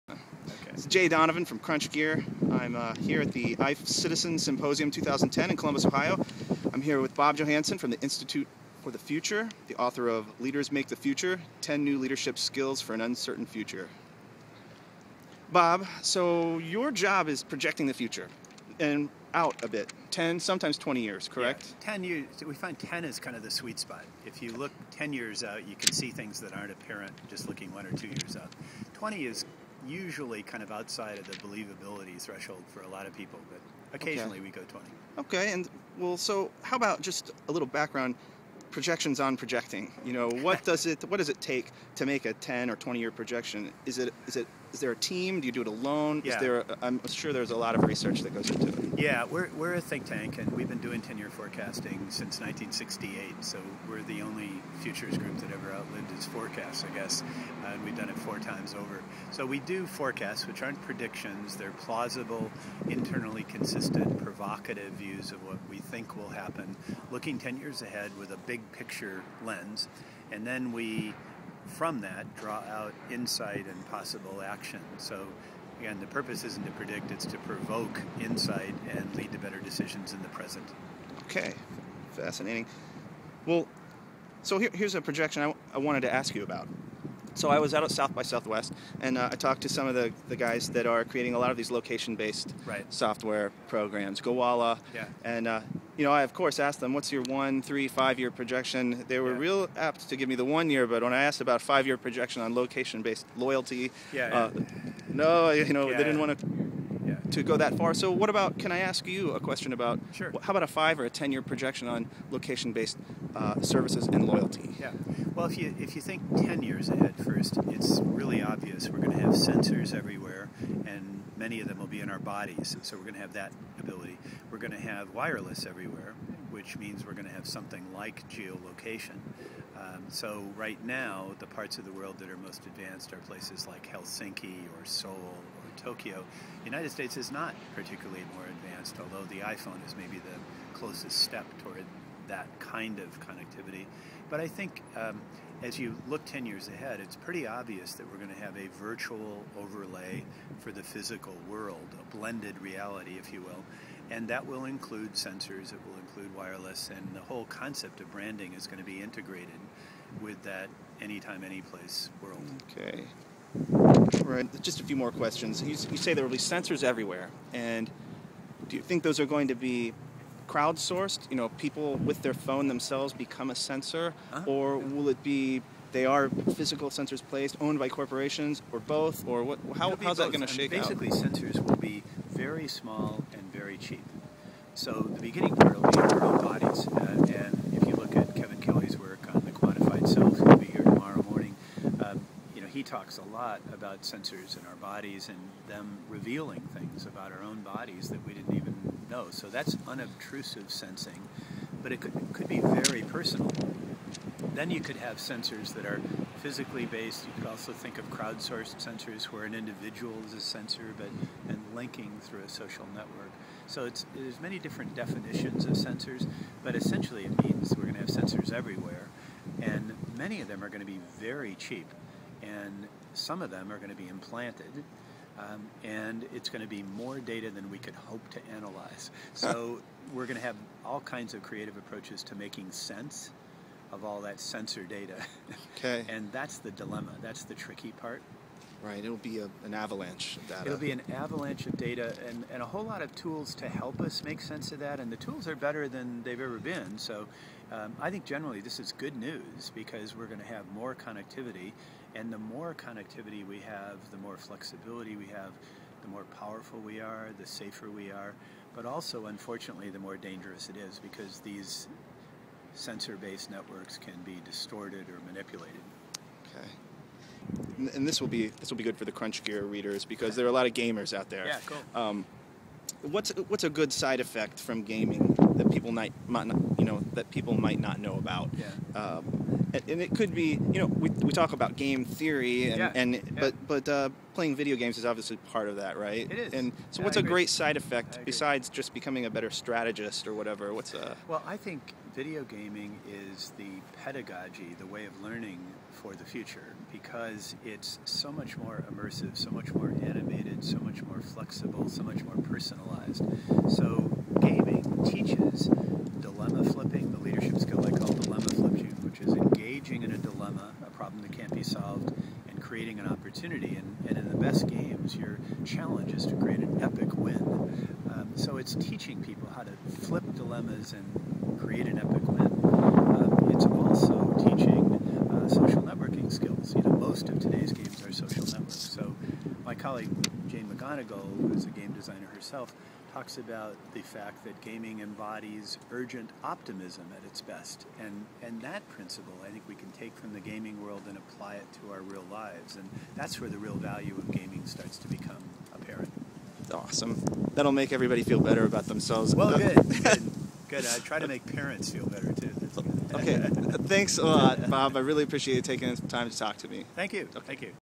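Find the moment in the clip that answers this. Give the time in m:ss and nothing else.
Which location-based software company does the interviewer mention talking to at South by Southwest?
1:34.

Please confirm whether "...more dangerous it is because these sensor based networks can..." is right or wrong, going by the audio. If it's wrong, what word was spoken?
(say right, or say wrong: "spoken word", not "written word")
right.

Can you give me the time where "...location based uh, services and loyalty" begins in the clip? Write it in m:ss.
1:52.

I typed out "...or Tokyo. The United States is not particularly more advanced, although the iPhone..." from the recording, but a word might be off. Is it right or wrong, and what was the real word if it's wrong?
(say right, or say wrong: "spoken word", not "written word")
right.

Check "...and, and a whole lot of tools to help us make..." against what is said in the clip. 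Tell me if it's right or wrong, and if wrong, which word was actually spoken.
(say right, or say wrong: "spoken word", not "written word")
right.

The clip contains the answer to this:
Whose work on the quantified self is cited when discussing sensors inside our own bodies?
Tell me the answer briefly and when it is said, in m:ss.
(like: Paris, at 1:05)
Kevin Kelly, at 3:08.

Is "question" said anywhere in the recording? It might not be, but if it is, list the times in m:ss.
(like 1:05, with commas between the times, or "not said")
1:49, 2:45.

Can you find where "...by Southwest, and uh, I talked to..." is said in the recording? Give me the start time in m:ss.
1:28.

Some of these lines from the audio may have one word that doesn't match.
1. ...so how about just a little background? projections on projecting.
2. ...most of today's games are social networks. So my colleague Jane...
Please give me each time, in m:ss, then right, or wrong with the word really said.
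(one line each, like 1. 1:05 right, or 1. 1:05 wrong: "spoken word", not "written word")
1. 0:36 right
2. 5:26 right.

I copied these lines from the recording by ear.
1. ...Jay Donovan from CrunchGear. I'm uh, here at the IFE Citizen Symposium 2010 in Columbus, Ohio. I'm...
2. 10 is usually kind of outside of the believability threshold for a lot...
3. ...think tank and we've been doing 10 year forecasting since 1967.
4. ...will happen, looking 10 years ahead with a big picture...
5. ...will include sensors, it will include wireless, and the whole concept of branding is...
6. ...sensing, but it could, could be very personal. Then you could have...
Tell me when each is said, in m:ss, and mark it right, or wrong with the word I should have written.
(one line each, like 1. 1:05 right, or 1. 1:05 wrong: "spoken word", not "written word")
1. 0:00 right
2. 0:28 wrong: "20", not "10"
3. 0:49 wrong: "1968", not "1967"
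4. 1:06 right
5. 2:34 right
6. 3:20 right.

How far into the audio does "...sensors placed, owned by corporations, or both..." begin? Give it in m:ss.
2:56.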